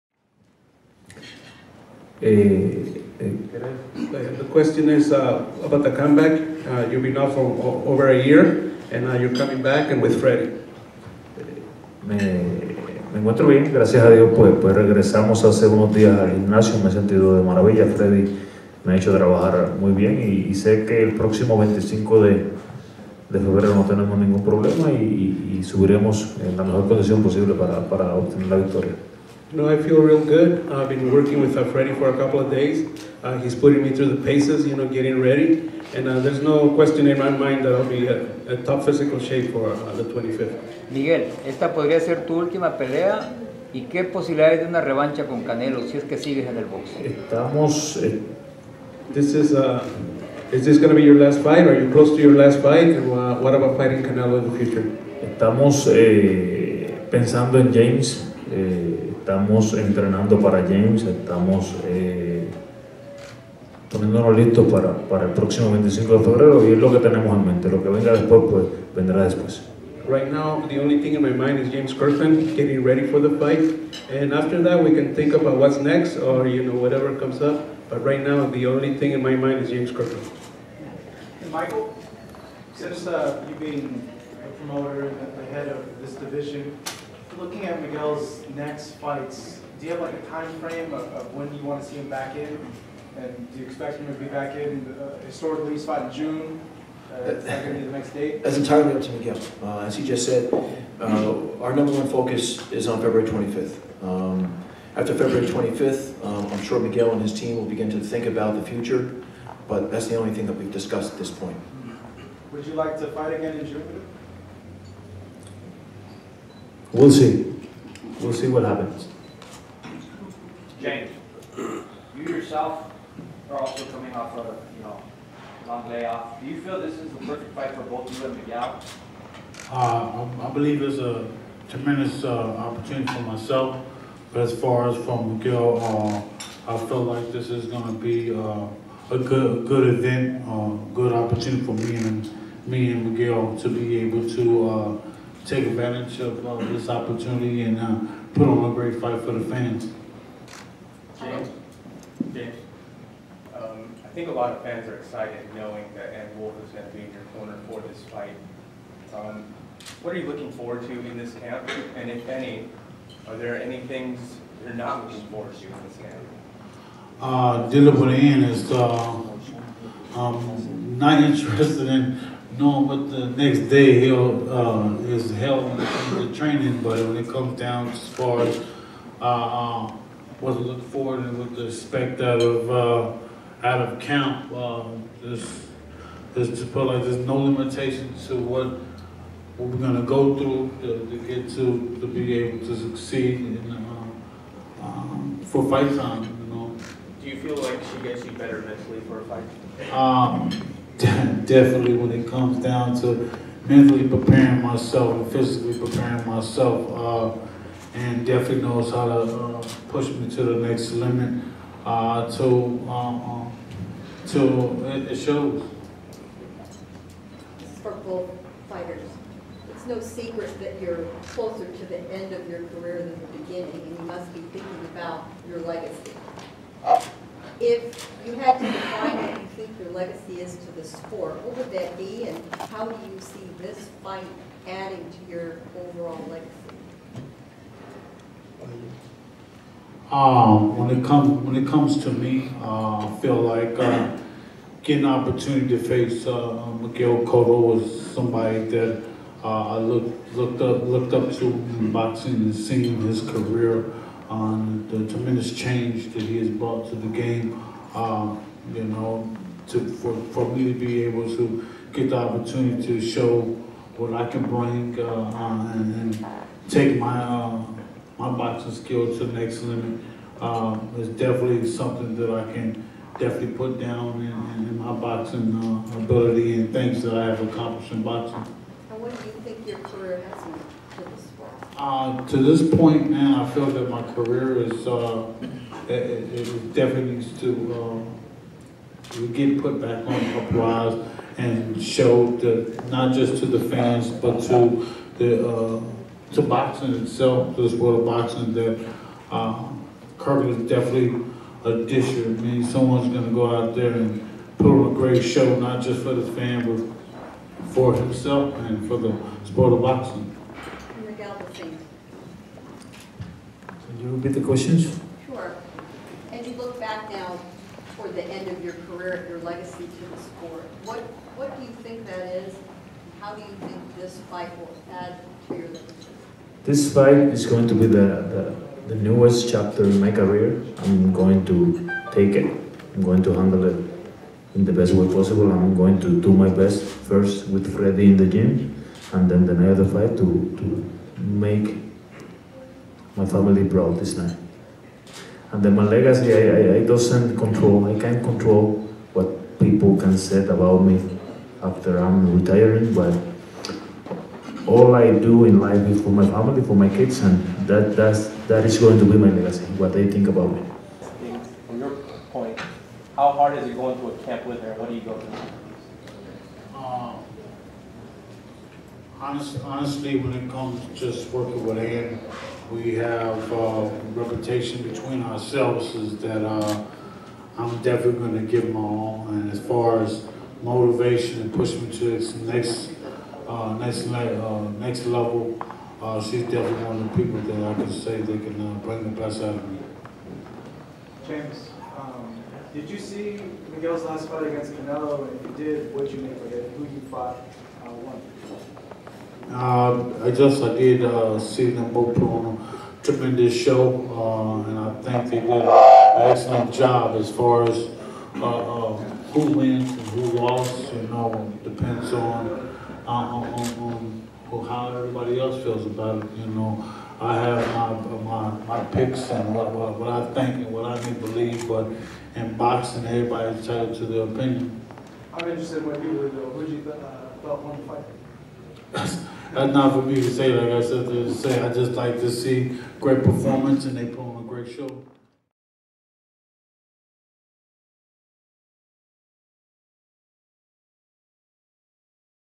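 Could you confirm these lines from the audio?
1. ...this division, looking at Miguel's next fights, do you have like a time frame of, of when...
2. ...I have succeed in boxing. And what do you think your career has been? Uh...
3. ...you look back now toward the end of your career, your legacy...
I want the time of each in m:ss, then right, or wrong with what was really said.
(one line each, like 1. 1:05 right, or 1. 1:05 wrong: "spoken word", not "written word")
1. 1:26 right
2. 4:37 wrong: "accomplished", not "succeed"
3. 5:16 right.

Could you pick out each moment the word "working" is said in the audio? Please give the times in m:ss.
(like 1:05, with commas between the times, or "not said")
0:31, 6:11.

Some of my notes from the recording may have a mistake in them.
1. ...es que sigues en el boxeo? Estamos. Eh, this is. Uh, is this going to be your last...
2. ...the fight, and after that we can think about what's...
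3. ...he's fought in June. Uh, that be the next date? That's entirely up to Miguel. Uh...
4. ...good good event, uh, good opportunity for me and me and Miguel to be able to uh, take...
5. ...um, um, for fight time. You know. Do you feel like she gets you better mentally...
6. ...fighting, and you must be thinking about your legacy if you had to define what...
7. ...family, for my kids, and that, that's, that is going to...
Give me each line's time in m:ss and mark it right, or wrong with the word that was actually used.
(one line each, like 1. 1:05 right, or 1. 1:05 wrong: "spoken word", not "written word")
1. 0:45 right
2. 1:13 right
3. 1:35 right
4. 2:19 right
5. 3:13 right
6. 3:43 wrong: "beginning", not "fighting"
7. 5:56 right.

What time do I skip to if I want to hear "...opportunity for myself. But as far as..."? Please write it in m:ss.
2:12.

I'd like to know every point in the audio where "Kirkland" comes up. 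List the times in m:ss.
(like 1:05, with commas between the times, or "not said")
1:11, 1:19.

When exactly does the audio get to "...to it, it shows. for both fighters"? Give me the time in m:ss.
3:34.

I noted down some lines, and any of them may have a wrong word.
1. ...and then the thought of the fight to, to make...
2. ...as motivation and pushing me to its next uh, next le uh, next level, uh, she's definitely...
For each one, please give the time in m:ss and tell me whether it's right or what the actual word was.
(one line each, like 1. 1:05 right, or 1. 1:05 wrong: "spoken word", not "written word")
1. 5:39 wrong: "night", not "thought"
2. 6:20 right.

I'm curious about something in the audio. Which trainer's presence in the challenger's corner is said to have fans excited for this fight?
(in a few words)
Ann Wolfe.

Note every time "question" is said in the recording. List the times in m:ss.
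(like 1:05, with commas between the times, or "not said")
0:04, 0:36, 5:14.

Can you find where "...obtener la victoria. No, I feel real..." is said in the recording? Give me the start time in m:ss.
0:28.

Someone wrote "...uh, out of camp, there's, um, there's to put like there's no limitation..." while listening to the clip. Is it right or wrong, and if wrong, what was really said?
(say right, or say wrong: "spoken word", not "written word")
right.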